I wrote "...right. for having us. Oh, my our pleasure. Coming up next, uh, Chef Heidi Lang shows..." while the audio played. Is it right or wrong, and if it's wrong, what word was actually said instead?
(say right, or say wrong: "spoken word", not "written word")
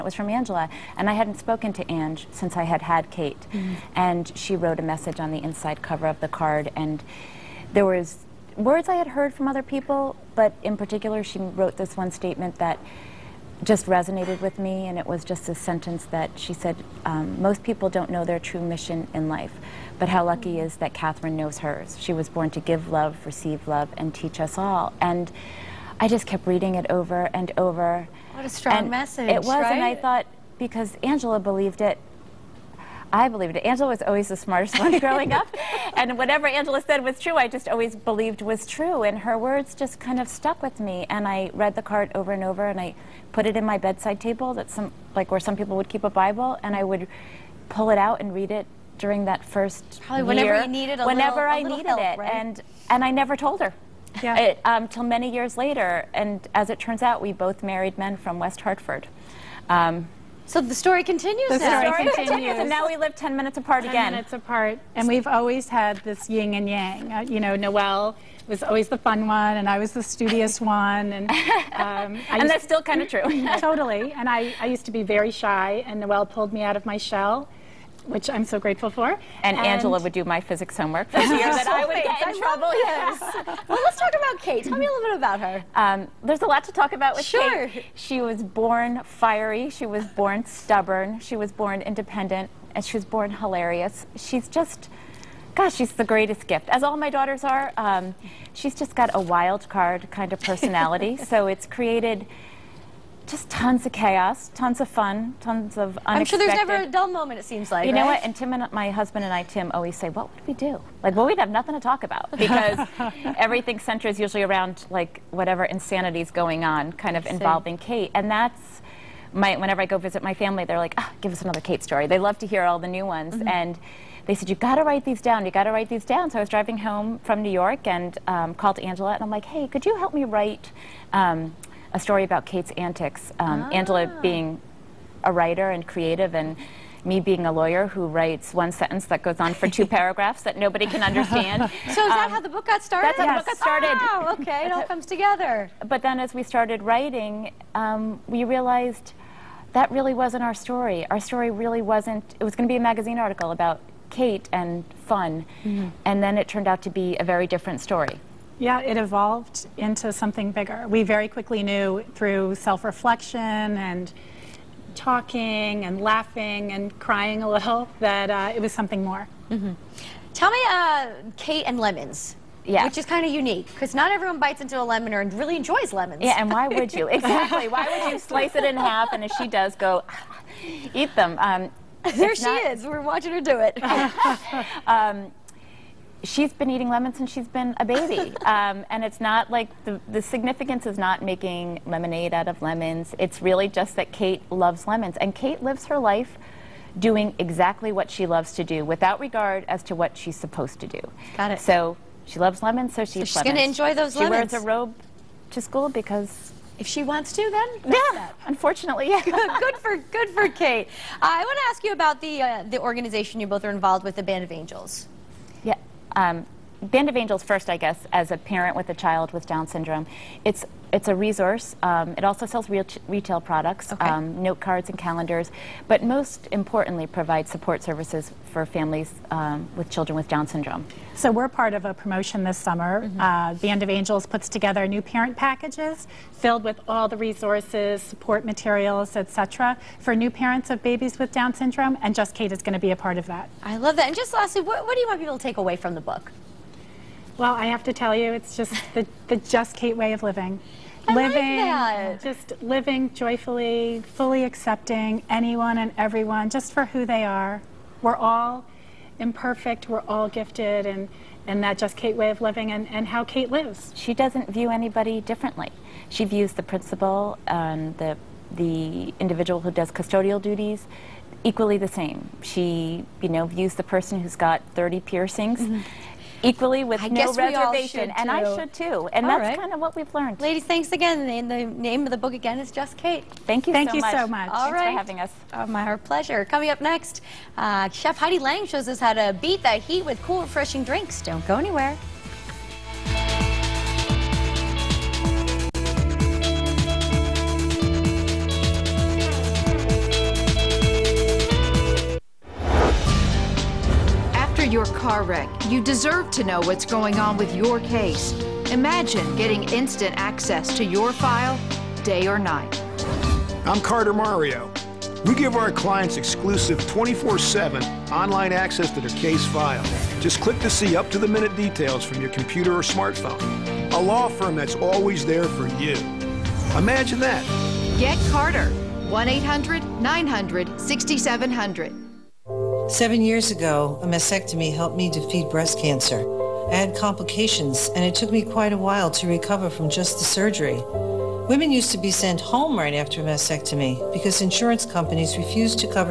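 right.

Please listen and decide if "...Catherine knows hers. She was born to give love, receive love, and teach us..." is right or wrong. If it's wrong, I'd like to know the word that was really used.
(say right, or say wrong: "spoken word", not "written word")
right.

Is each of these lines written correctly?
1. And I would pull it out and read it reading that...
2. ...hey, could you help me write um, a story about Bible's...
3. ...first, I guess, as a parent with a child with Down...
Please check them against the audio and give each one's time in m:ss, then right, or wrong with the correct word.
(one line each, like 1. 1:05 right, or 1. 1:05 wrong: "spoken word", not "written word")
1. 0:46 wrong: "during", not "reading"
2. 2:09 wrong: "Kate", not "Bible"
3. 3:37 right.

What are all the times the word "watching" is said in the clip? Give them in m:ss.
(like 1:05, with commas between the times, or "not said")
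3:03.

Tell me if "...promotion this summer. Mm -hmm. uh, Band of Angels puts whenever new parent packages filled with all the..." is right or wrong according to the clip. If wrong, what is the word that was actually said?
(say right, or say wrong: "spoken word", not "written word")
wrong: "together", not "whenever".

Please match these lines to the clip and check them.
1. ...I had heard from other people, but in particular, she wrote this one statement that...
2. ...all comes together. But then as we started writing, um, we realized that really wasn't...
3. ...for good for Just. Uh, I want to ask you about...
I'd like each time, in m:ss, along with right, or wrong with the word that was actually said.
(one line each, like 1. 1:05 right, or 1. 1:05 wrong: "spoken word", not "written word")
1. 0:08 right
2. 2:24 right
3. 3:29 wrong: "Kate", not "Just".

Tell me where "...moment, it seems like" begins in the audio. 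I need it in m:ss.
1:47.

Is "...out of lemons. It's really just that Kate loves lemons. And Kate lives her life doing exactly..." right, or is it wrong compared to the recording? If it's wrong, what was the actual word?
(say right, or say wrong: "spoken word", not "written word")
right.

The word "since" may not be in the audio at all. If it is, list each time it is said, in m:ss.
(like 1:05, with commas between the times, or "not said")
0:02, 3:07.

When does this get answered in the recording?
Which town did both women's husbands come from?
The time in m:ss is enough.
0:58.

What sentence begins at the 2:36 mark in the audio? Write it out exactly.
and then it turned out to be a very different story.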